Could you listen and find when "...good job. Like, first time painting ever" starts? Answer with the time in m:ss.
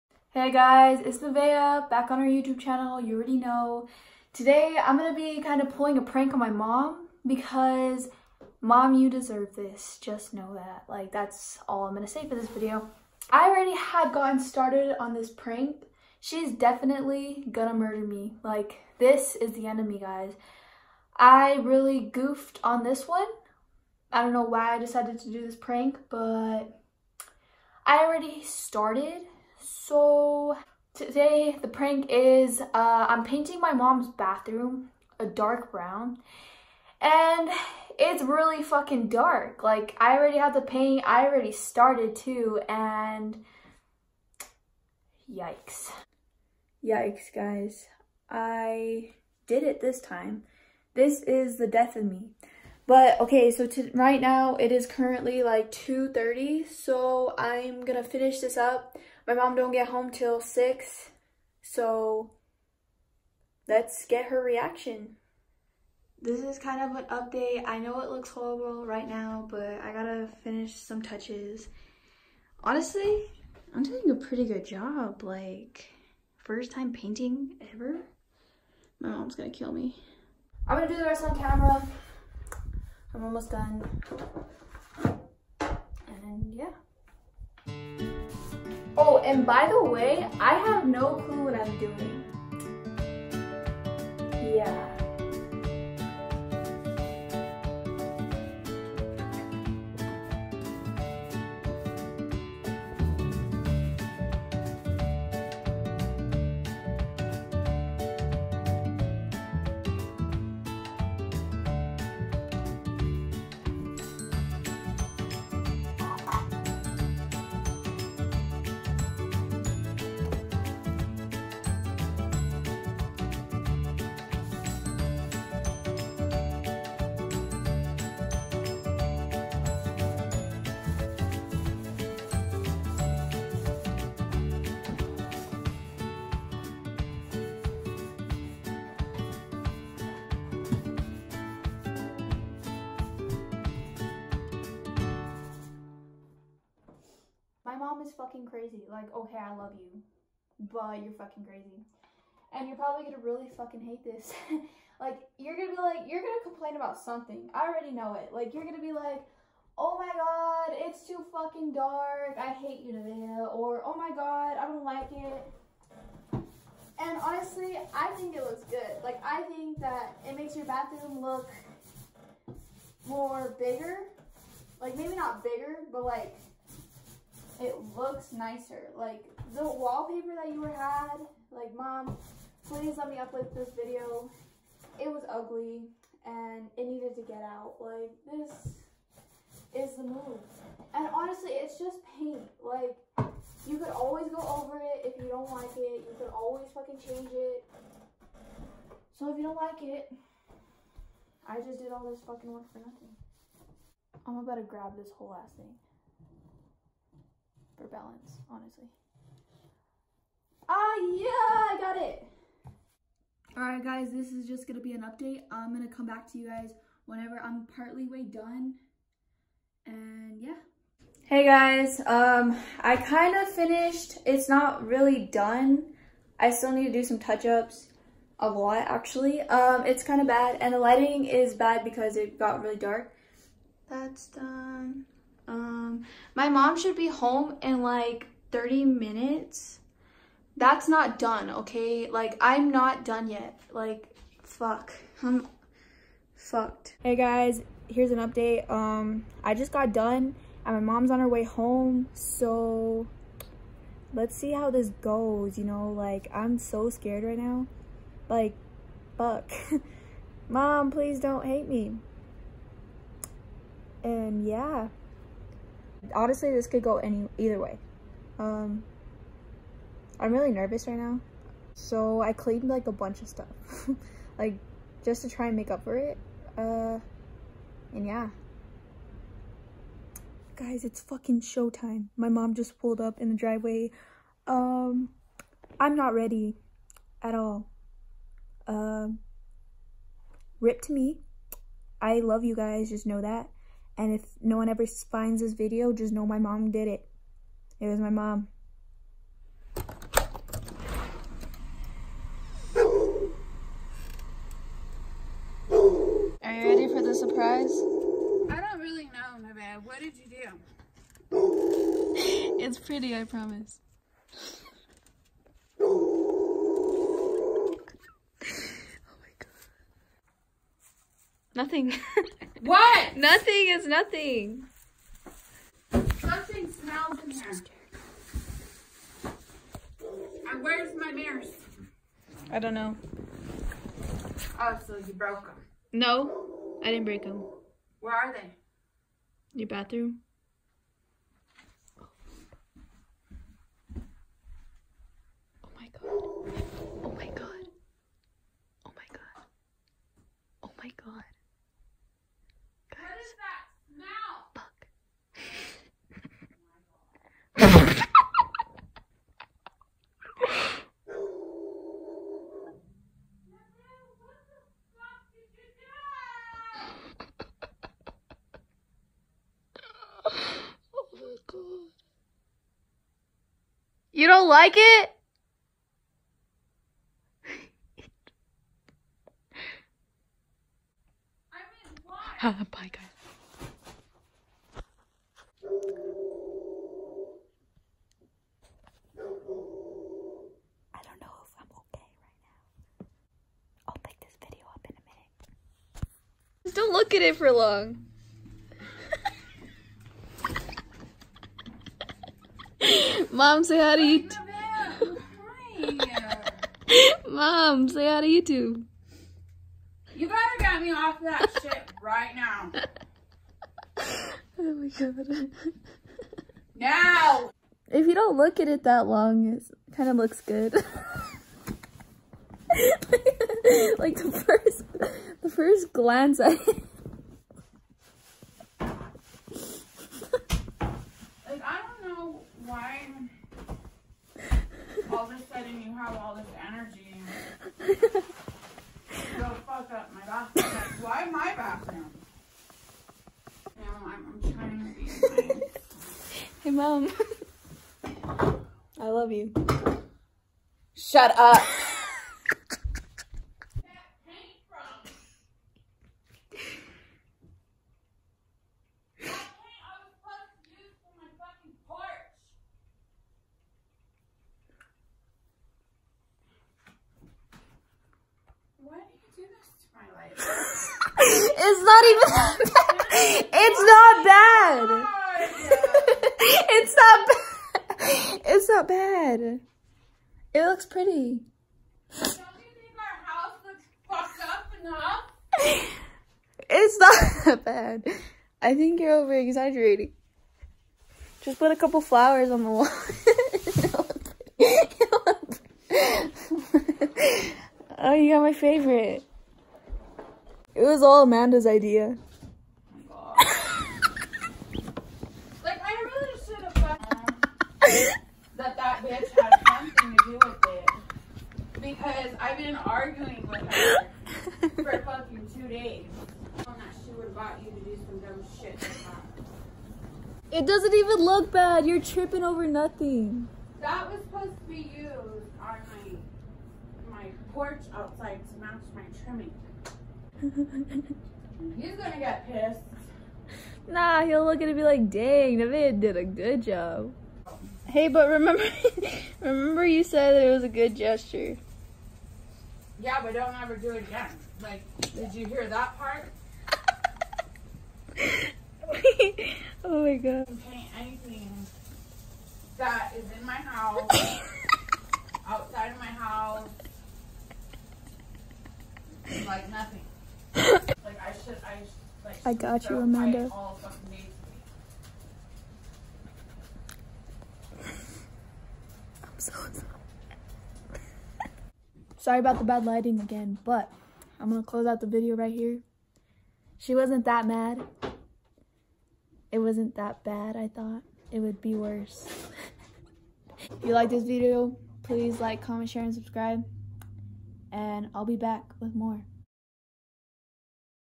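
1:14.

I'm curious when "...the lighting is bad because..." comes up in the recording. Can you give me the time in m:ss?
3:50.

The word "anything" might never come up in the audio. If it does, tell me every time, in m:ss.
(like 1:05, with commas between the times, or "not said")
9:10.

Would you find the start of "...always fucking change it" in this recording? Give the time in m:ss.
3:16.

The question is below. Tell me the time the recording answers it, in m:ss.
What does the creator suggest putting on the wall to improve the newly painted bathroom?
8:11.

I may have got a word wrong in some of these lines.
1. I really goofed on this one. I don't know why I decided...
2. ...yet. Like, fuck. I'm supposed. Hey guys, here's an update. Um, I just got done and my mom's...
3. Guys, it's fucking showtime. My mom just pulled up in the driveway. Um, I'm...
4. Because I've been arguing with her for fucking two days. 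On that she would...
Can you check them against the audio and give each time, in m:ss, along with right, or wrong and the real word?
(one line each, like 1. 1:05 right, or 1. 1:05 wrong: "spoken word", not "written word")
1. 0:21 right
2. 4:03 wrong: "fucked", not "supposed"
3. 4:40 right
4. 8:31 right.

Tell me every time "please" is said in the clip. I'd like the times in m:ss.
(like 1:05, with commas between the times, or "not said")
3:02, 4:20, 9:45.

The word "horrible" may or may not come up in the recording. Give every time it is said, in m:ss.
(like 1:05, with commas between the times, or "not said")
1:08.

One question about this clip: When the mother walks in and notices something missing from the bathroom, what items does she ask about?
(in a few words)
Mirrors.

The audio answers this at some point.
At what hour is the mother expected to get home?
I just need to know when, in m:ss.
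1:00.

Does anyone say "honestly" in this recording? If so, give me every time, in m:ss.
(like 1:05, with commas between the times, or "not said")
1:12, 2:47, 3:11, 3:28, 4:26.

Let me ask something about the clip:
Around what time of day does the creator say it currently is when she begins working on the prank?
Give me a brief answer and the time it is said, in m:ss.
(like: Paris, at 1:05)
2:30, at 0:55.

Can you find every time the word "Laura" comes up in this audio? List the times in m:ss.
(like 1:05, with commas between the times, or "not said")
not said.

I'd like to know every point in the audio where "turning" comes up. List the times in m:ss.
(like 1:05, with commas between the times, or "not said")
not said.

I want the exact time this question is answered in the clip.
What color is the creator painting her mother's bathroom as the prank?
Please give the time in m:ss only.
0:35.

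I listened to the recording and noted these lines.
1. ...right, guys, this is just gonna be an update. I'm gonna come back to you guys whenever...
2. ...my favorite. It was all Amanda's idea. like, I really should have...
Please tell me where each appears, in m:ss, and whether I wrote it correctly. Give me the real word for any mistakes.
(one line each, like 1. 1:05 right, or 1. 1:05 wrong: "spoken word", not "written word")
1. 3:33 right
2. 8:18 right.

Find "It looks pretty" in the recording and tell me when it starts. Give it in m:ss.
8:00.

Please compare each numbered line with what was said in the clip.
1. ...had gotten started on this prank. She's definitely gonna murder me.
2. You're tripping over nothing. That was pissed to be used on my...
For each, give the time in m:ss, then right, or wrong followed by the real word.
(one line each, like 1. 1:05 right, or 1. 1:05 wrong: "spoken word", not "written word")
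1. 0:13 right
2. 8:41 wrong: "supposed", not "pissed".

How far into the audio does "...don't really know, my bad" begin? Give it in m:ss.
5:08.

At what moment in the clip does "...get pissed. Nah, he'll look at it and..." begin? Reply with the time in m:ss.
8:52.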